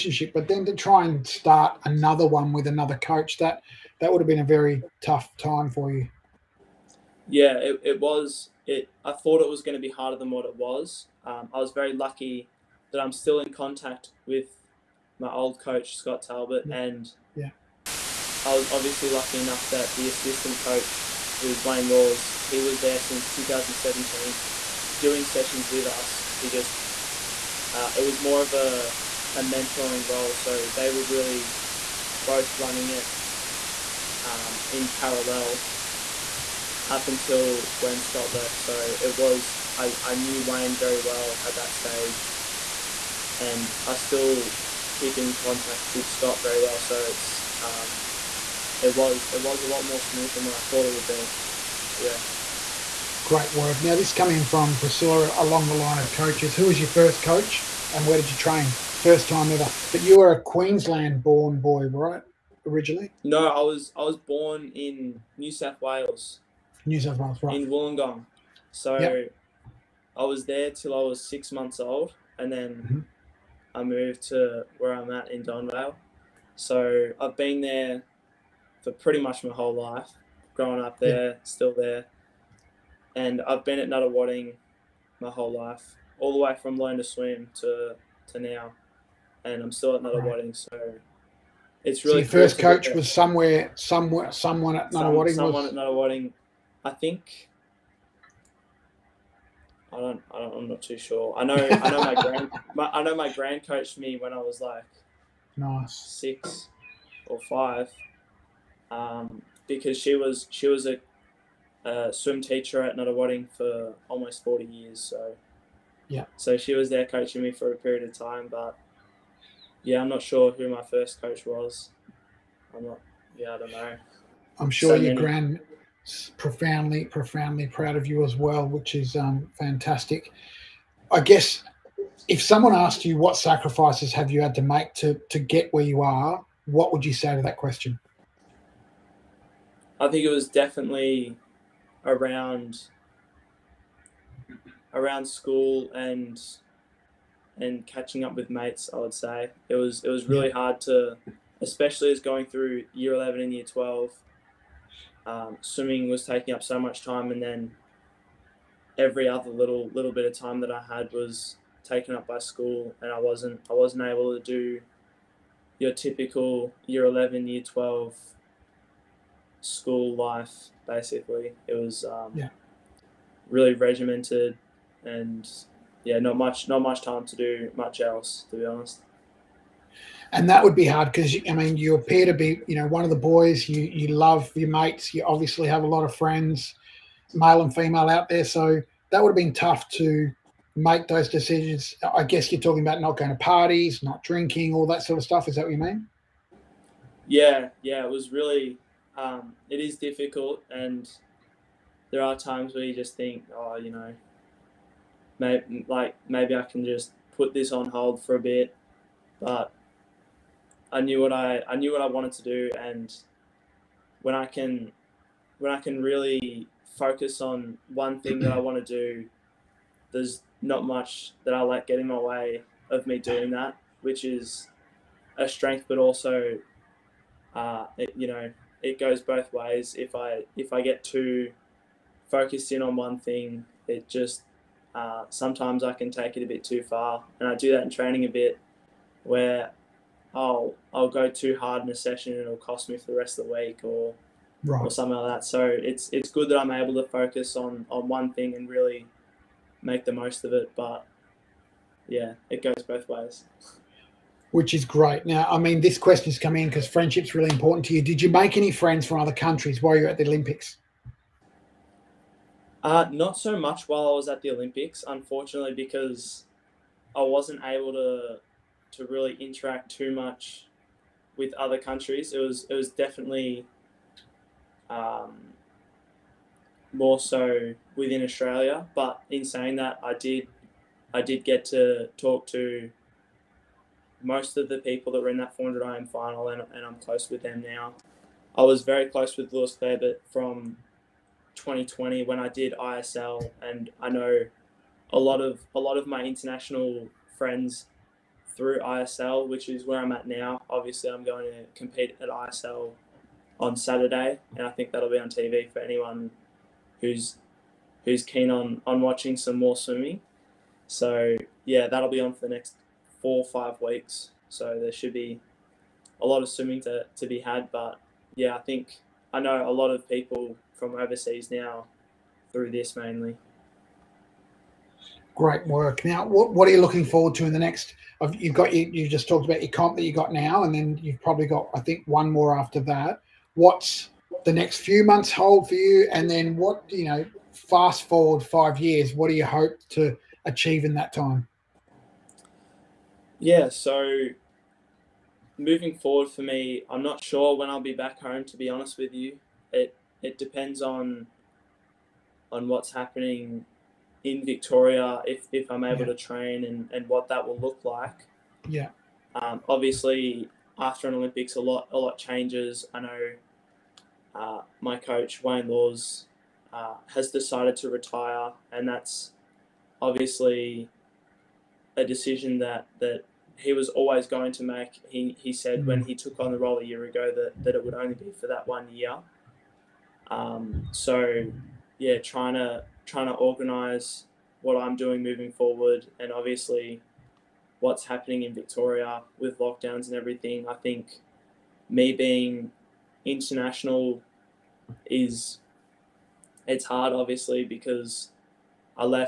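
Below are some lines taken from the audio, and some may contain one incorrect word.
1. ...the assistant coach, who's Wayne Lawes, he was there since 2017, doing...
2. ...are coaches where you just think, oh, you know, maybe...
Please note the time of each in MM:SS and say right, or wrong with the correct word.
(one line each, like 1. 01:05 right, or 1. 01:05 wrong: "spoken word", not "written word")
1. 00:19 right
2. 03:22 wrong: "times", not "coaches".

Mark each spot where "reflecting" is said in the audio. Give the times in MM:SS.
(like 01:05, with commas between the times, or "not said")
not said.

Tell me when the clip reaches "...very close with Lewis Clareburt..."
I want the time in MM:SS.
04:48.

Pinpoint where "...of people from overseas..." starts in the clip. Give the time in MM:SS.
05:19.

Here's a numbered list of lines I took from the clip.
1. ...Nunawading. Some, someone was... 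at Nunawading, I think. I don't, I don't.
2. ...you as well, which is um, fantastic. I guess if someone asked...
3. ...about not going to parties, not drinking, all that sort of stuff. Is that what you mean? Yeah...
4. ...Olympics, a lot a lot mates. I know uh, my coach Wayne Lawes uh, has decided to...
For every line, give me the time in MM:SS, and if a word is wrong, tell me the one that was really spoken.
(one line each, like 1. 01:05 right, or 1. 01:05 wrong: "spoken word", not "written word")
1. 01:34 right
2. 02:08 right
3. 03:12 right
4. 06:01 wrong: "changes", not "mates".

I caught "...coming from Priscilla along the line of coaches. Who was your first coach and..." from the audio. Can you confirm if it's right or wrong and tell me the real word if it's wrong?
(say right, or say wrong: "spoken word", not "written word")
right.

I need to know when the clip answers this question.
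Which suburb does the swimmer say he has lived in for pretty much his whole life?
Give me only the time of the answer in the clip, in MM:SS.
01:15.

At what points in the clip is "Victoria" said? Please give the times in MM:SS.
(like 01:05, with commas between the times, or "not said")
05:54, 06:28.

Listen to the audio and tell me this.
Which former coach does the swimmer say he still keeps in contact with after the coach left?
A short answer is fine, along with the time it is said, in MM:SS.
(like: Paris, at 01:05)
Scott Talbot, at 00:15.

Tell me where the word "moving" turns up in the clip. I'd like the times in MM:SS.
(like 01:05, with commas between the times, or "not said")
05:45, 06:25.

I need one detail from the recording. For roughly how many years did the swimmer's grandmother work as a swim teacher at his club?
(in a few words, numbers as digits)
40.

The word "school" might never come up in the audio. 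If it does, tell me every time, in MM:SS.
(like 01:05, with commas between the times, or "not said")
02:25, 02:42, 02:49.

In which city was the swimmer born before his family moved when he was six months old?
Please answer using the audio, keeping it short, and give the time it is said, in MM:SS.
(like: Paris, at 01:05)
Wollongong, at 01:07.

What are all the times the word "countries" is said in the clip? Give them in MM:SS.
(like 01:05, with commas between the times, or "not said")
04:19, 04:31.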